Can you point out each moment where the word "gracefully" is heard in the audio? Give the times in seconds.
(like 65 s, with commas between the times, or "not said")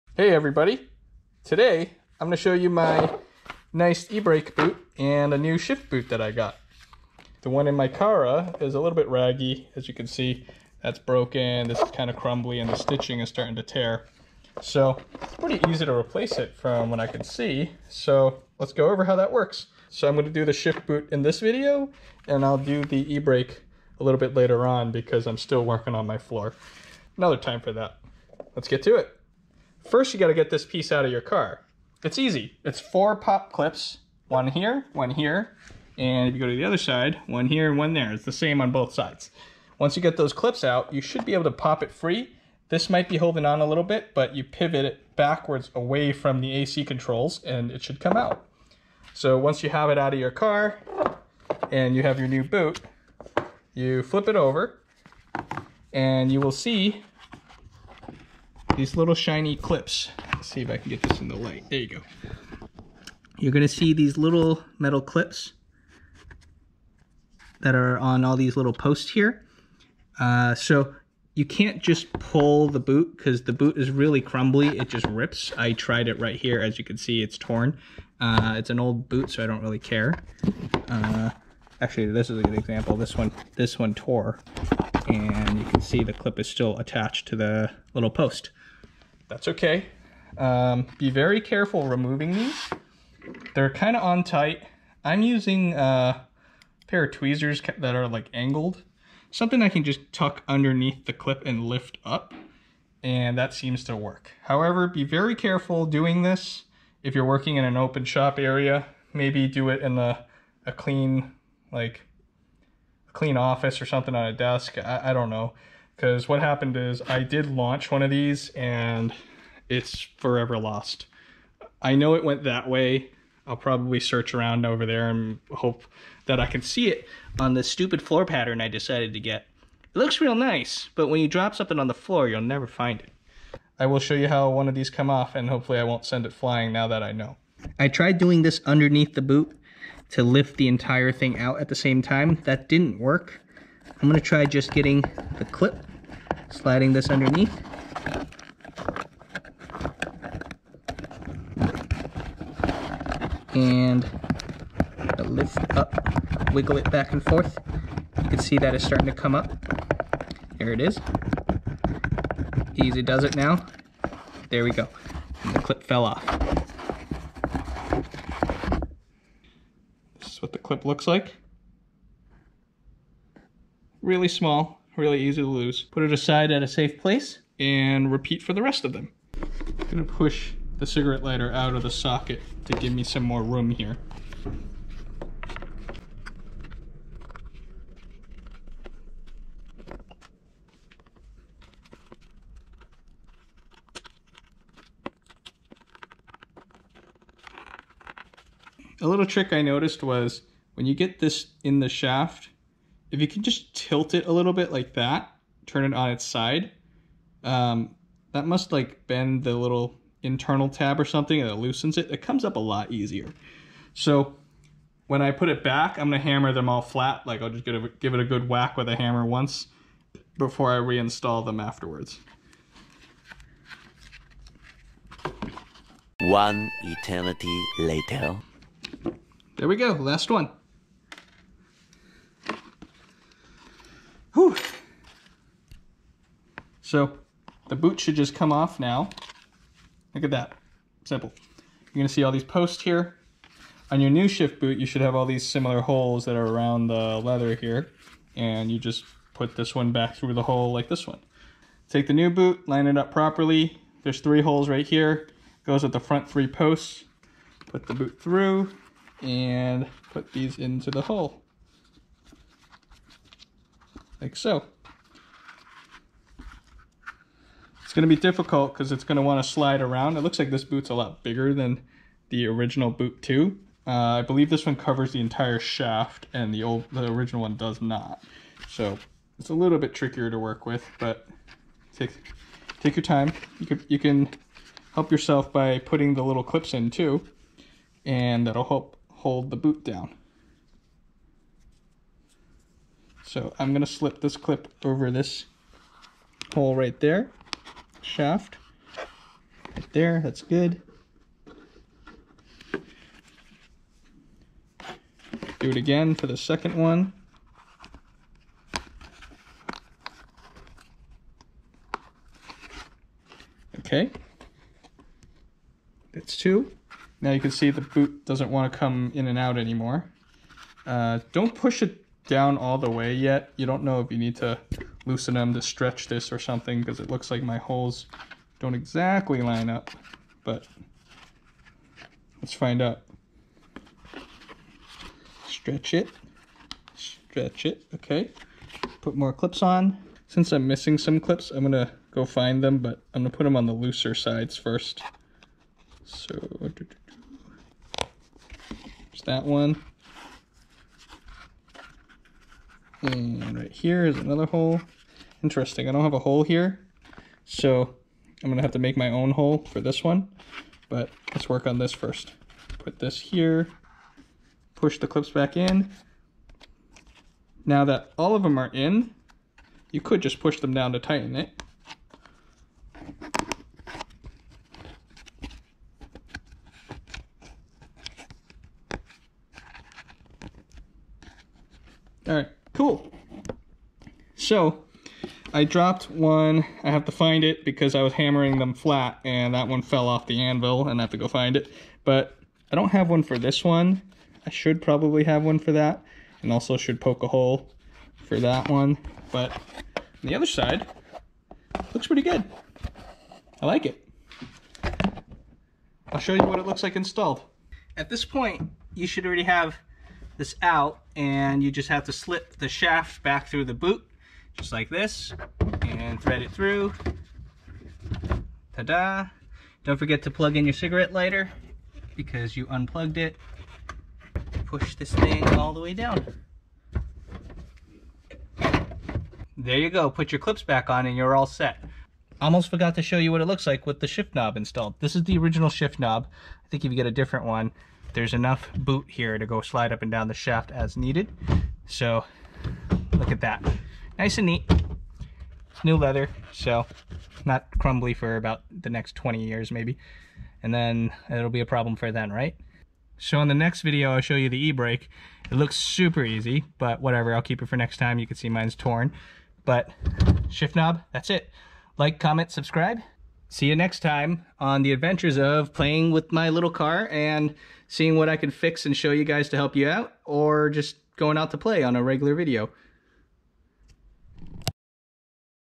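not said.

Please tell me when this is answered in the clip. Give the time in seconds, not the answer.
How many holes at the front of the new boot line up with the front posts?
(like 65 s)
254 s.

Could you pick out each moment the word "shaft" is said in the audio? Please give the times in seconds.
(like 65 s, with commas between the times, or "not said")
201 s, 275 s, 298 s, 412 s, 440 s.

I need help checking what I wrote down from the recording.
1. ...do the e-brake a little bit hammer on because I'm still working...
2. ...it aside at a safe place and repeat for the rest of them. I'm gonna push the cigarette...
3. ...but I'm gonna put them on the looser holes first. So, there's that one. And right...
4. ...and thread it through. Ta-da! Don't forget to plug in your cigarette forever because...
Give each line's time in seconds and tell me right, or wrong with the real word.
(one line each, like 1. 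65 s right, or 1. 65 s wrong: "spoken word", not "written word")
1. 22 s wrong: "later", not "hammer"
2. 176 s right
3. 342 s wrong: "sides", not "holes"
4. 415 s wrong: "lighter", not "forever".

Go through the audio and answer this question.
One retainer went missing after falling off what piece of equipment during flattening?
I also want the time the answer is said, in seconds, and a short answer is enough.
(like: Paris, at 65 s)
anvil, at 390 s.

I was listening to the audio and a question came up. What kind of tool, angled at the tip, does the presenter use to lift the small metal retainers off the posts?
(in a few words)
tweezers.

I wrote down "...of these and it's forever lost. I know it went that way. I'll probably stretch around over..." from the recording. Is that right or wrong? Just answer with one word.
wrong.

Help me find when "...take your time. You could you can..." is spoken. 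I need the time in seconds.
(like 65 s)
282 s.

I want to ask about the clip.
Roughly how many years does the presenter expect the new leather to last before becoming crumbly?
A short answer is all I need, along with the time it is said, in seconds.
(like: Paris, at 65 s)
20, at 449 s.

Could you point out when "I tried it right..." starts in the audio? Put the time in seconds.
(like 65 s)
75 s.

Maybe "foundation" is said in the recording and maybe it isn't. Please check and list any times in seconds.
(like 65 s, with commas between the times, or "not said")
not said.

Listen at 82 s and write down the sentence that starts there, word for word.
This one, this one tore, and you can see the clip is still attached to the little post.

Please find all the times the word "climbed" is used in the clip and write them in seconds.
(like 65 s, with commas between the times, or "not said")
not said.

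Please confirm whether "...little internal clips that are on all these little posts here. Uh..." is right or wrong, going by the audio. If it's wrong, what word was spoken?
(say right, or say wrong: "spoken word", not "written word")
wrong: "metal", not "internal".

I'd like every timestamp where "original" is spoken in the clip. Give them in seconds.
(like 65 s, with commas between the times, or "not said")
272 s, 277 s, 435 s.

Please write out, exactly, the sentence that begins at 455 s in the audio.
It looks super easy, but whatever, I'll keep it for next time.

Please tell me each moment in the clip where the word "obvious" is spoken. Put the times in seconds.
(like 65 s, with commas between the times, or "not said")
not said.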